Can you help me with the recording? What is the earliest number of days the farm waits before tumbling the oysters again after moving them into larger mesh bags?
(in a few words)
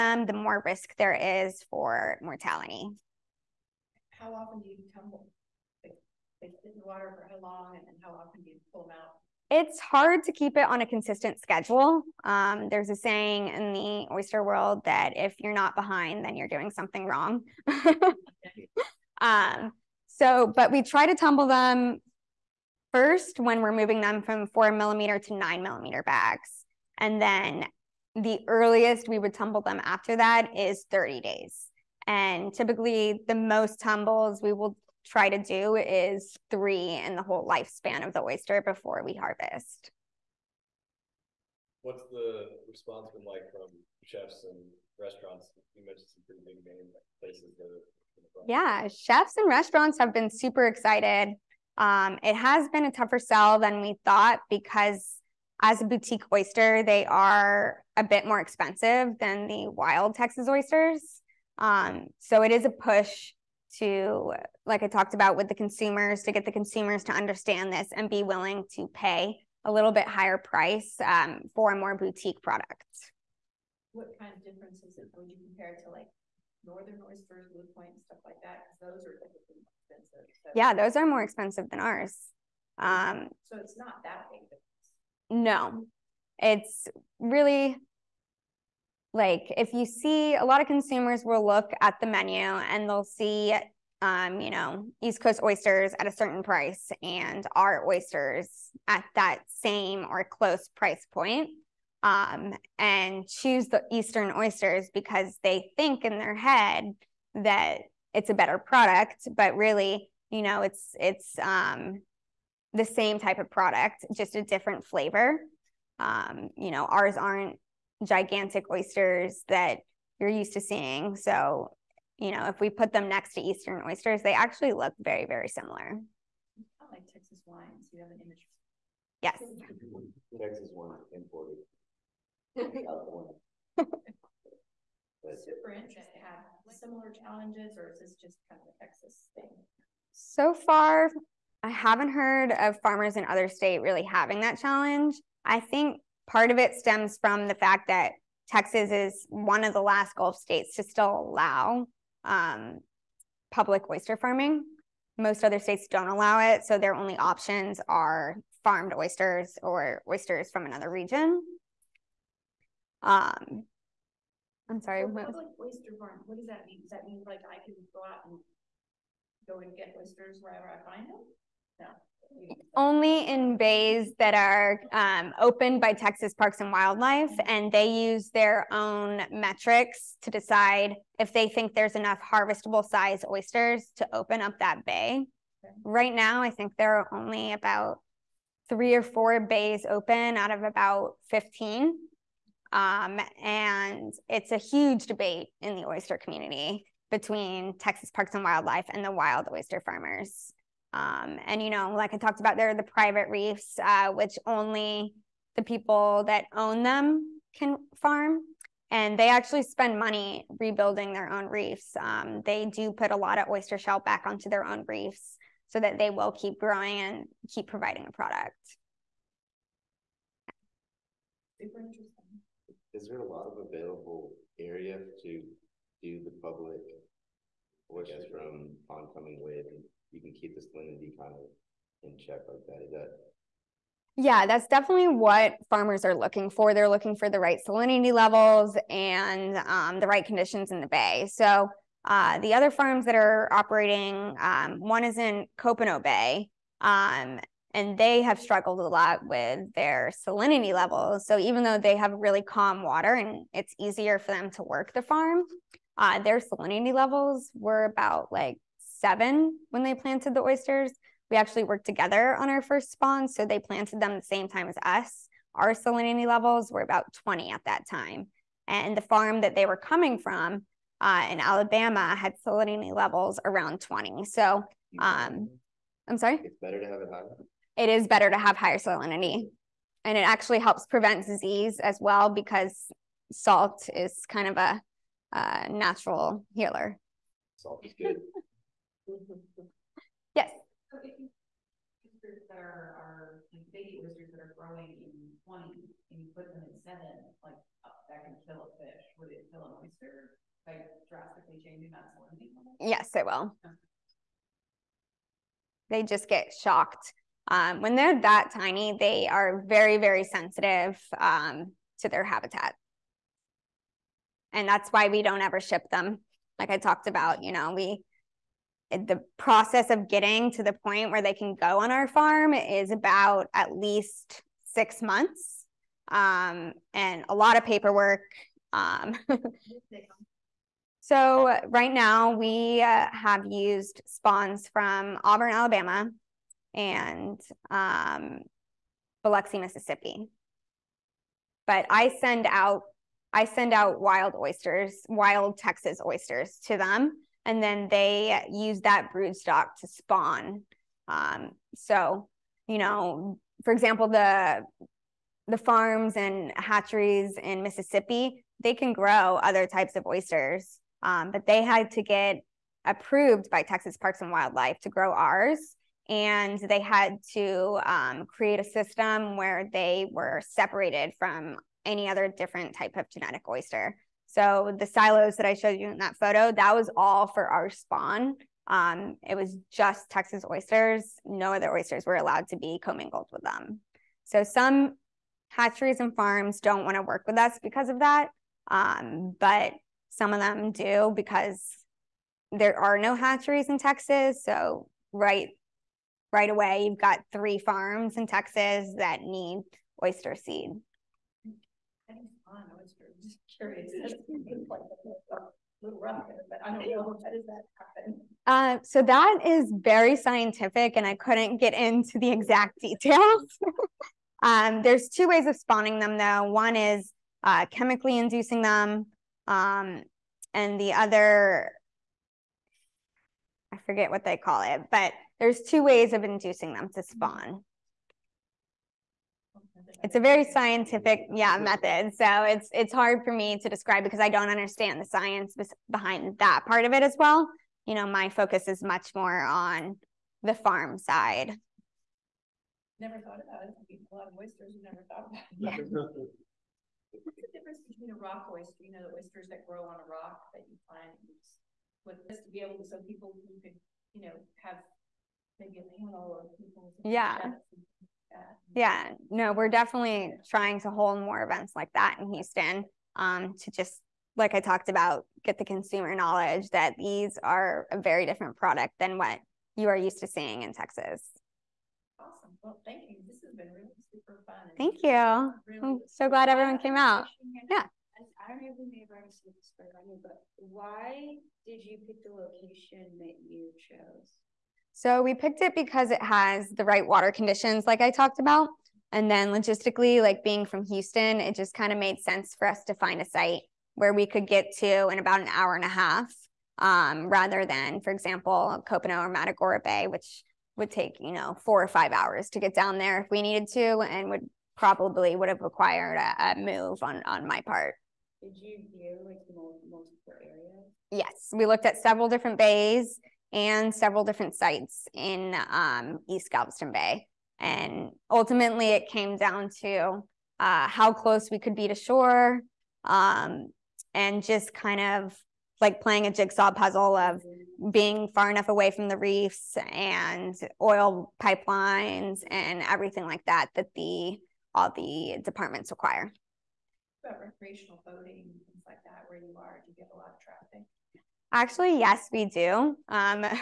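30 days.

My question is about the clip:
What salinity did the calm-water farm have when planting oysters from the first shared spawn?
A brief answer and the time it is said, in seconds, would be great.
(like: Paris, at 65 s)
7, at 259 s.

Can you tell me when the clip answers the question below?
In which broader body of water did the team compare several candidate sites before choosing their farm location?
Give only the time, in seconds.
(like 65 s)
516 s.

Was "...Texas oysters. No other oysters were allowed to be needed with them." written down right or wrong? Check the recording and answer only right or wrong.
wrong.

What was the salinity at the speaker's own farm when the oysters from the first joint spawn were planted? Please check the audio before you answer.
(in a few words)
20.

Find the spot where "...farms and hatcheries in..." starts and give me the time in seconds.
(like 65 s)
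355 s.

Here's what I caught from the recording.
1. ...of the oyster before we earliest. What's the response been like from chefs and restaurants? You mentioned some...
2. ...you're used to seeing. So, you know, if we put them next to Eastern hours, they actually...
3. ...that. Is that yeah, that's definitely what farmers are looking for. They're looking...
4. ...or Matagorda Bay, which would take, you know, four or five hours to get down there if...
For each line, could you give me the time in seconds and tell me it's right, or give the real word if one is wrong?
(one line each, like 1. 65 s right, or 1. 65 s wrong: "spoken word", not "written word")
1. 38 s wrong: "harvest", not "earliest"
2. 120 s wrong: "oysters", not "hours"
3. 232 s right
4. 499 s right.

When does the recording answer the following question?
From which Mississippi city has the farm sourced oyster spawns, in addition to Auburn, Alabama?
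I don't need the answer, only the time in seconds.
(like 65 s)
339 s.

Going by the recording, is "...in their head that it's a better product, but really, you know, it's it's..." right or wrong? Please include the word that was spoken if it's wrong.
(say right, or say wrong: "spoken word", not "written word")
right.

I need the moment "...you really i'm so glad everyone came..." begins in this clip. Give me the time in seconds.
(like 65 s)
475 s.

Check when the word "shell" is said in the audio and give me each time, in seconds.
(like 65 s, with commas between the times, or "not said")
213 s.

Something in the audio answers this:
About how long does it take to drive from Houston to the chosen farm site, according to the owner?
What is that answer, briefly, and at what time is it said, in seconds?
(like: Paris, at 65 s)
an hour and a half, at 495 s.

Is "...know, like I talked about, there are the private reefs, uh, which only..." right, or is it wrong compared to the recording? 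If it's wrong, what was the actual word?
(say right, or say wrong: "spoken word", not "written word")
right.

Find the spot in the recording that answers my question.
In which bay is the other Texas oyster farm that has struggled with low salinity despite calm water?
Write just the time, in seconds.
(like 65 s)
245 s.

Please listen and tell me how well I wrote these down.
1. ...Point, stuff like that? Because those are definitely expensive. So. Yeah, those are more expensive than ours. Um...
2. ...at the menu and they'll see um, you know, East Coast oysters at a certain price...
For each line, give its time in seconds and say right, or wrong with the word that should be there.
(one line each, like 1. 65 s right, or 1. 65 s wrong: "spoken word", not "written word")
1. 77 s wrong: "typically", not "definitely"
2. 91 s right.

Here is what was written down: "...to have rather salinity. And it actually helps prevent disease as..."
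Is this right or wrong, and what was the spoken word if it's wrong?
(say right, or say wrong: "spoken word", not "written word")
wrong: "higher", not "rather".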